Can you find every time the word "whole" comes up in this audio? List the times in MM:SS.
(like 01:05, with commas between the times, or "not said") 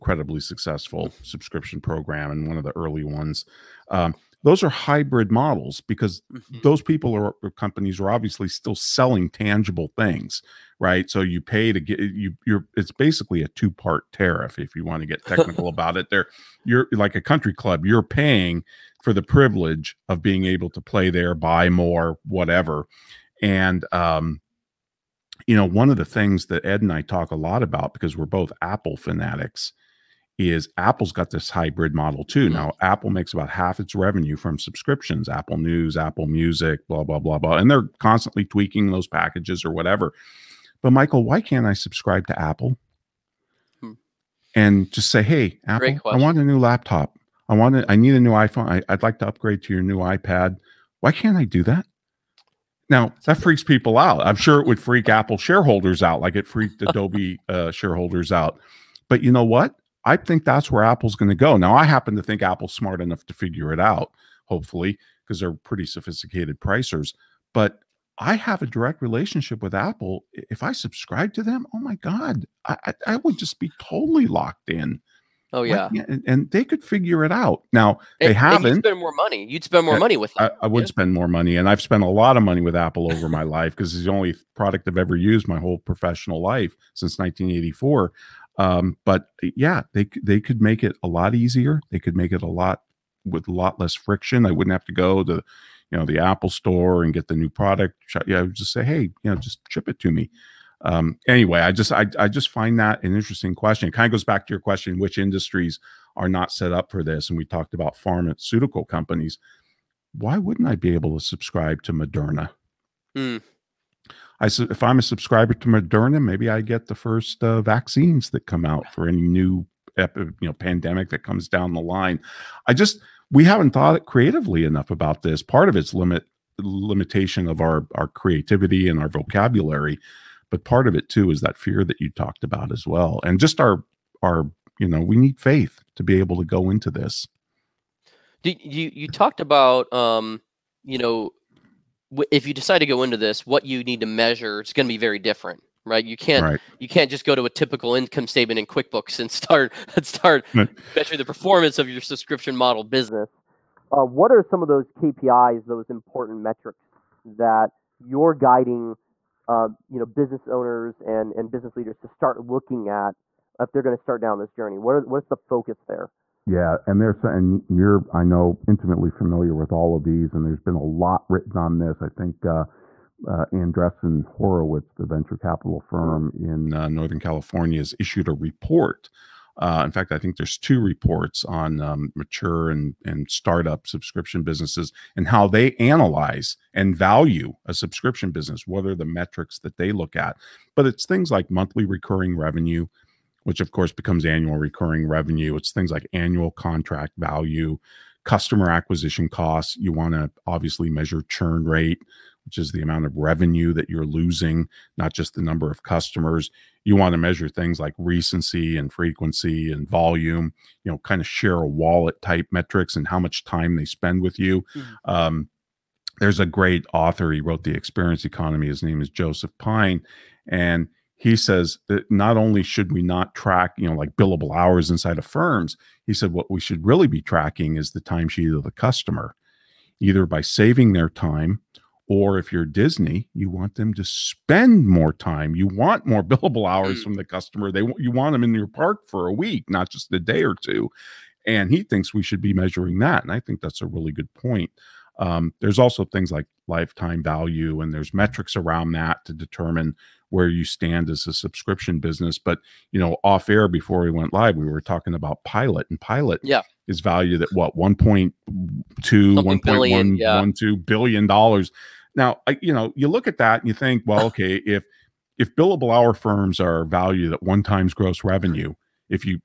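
01:25.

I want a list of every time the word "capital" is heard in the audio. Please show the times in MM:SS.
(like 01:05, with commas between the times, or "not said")
02:55.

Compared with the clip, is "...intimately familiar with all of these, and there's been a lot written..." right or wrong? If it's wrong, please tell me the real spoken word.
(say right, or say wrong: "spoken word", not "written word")
right.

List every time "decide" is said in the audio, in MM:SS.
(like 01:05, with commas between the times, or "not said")
02:22.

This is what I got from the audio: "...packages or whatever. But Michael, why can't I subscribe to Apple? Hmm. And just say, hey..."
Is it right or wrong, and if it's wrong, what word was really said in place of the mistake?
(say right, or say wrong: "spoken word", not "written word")
right.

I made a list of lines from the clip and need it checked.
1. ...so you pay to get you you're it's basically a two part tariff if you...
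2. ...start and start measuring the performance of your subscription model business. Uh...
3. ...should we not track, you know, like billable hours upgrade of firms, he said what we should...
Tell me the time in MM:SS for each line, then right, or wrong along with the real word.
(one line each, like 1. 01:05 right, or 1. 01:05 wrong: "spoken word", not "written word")
1. 00:11 right
2. 02:29 right
3. 03:42 wrong: "inside", not "upgrade".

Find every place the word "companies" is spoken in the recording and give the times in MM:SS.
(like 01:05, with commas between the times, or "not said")
00:07, 01:48.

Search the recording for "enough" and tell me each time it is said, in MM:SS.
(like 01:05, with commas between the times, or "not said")
01:03, 02:04.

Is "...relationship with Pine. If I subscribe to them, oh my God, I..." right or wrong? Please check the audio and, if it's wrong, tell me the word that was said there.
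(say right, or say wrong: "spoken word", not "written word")
wrong: "Apple", not "Pine".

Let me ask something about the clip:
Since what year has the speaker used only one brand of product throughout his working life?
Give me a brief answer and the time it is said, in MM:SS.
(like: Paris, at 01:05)
1984, at 01:27.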